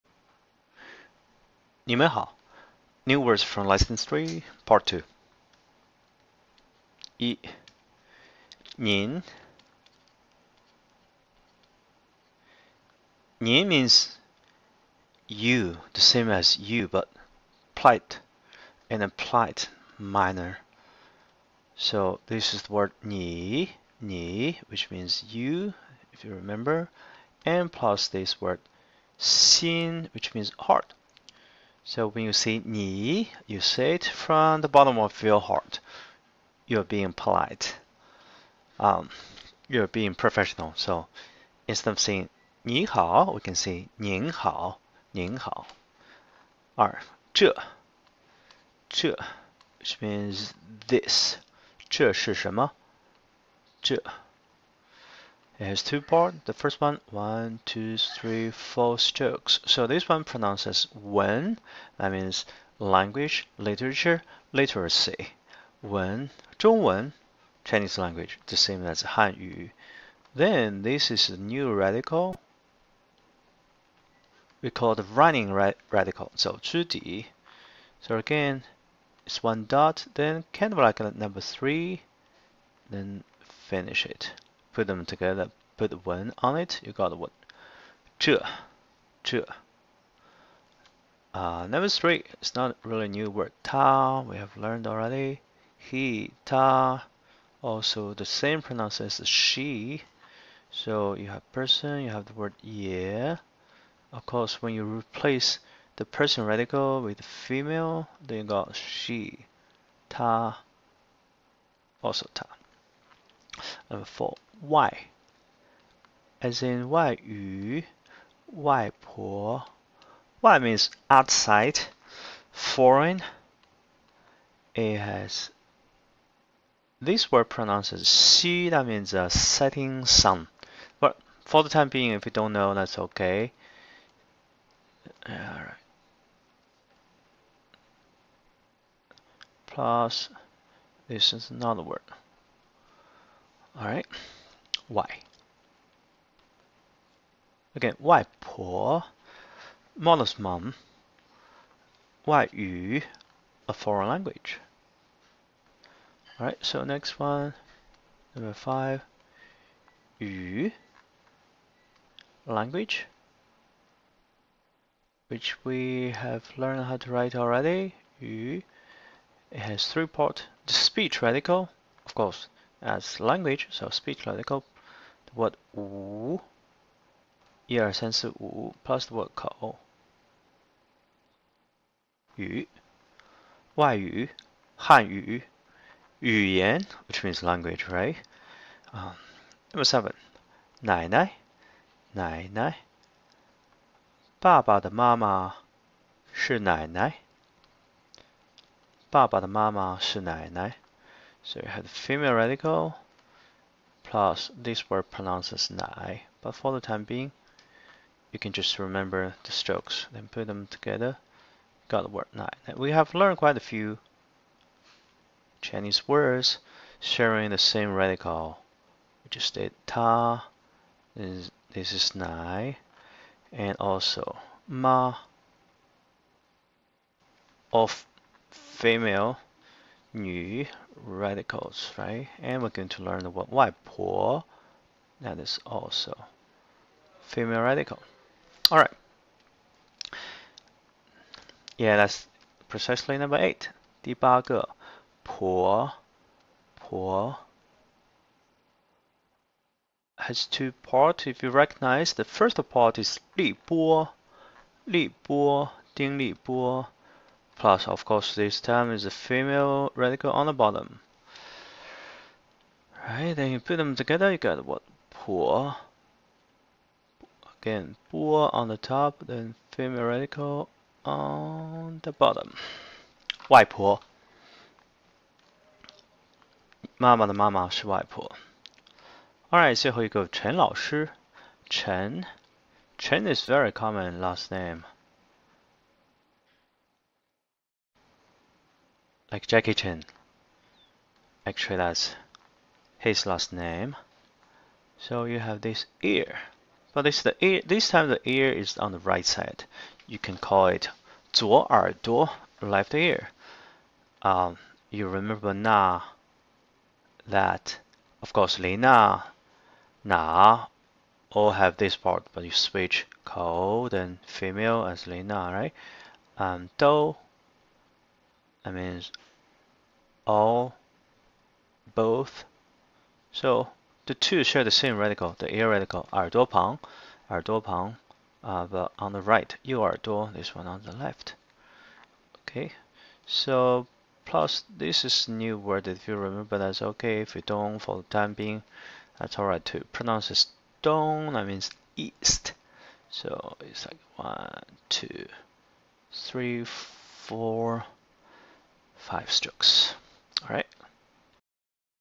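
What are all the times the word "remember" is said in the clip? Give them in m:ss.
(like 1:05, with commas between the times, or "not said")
0:26, 3:28, 5:05, 5:36.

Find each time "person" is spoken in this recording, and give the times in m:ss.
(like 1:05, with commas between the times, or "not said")
1:41, 1:46.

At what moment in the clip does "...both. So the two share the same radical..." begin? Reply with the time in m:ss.
5:21.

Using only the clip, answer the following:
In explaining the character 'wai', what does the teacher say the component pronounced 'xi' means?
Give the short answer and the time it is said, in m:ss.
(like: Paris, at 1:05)
a setting sun, at 2:09.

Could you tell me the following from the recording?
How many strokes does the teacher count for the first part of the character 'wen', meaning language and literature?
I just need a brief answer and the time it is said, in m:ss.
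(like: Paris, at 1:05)
4, at 0:57.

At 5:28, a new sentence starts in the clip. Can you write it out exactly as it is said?
uh, but on the right, 右 耳 朵, this one on the left.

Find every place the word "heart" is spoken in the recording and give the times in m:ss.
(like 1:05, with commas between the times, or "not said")
0:30, 0:35.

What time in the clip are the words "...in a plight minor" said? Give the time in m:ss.
0:18.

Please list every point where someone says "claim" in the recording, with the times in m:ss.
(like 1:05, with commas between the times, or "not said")
not said.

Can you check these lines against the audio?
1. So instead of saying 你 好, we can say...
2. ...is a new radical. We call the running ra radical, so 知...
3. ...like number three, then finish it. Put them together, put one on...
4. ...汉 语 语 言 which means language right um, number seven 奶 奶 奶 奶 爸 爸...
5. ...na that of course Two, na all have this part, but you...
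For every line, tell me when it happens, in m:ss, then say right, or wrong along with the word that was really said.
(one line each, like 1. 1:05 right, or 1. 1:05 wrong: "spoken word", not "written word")
1. 0:40 right
2. 1:11 right
3. 1:20 right
4. 3:04 right
5. 5:05 wrong: "Lena", not "Two".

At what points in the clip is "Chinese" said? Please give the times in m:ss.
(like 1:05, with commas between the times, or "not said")
1:07, 3:35.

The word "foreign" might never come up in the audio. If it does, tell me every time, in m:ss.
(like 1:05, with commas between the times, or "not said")
2:02, 2:33.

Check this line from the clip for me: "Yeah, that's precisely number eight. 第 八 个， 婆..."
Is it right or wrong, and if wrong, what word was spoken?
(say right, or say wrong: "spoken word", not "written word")
right.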